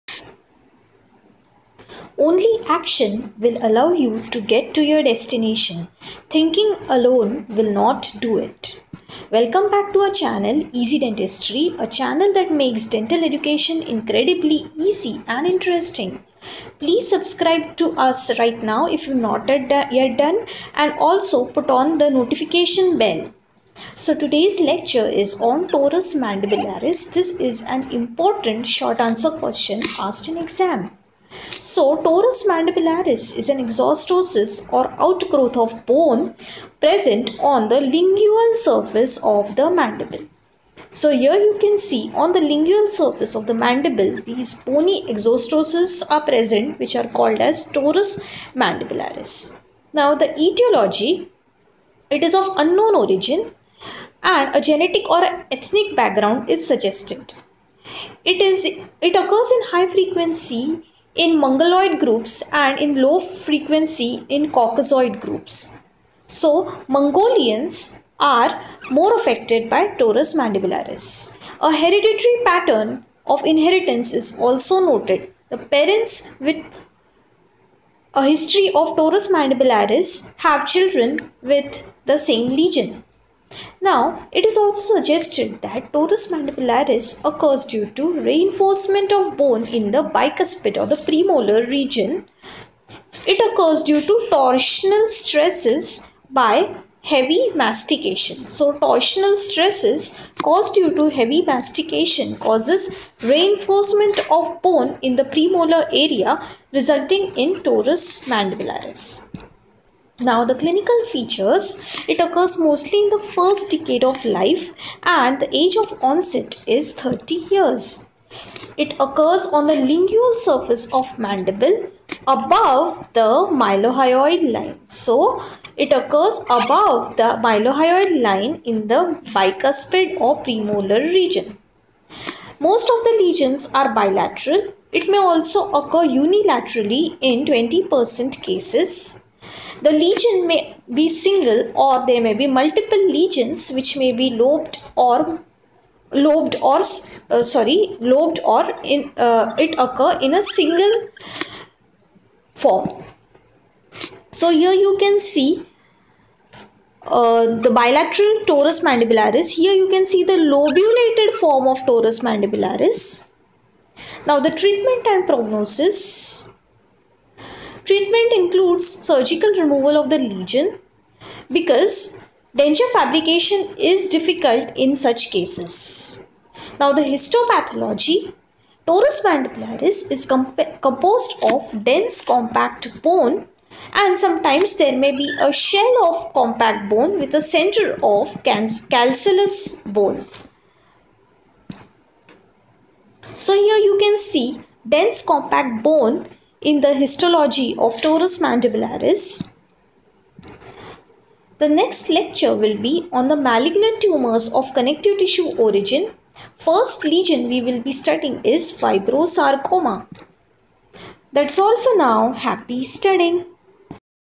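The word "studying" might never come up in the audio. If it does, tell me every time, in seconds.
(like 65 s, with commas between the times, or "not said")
207 s, 212 s.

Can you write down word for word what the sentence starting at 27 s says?
This is an important short answer question asked in exam.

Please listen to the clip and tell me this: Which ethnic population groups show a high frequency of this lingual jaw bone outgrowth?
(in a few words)
Mongoloid groups.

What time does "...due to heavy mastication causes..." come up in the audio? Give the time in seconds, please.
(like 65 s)
100 s.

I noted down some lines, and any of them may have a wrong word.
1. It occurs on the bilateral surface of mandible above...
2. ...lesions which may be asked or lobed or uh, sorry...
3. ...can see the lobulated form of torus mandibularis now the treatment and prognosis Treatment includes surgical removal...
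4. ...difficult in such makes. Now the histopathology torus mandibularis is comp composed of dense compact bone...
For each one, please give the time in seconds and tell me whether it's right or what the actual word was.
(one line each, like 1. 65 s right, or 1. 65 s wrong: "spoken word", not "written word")
1. 118 s wrong: "lingual", not "bilateral"
2. 143 s wrong: "lobed", not "asked"
3. 159 s right
4. 174 s wrong: "cases", not "makes".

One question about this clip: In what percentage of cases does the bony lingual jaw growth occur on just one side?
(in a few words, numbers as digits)
20%.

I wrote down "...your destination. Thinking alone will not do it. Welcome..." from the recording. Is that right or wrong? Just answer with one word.
right.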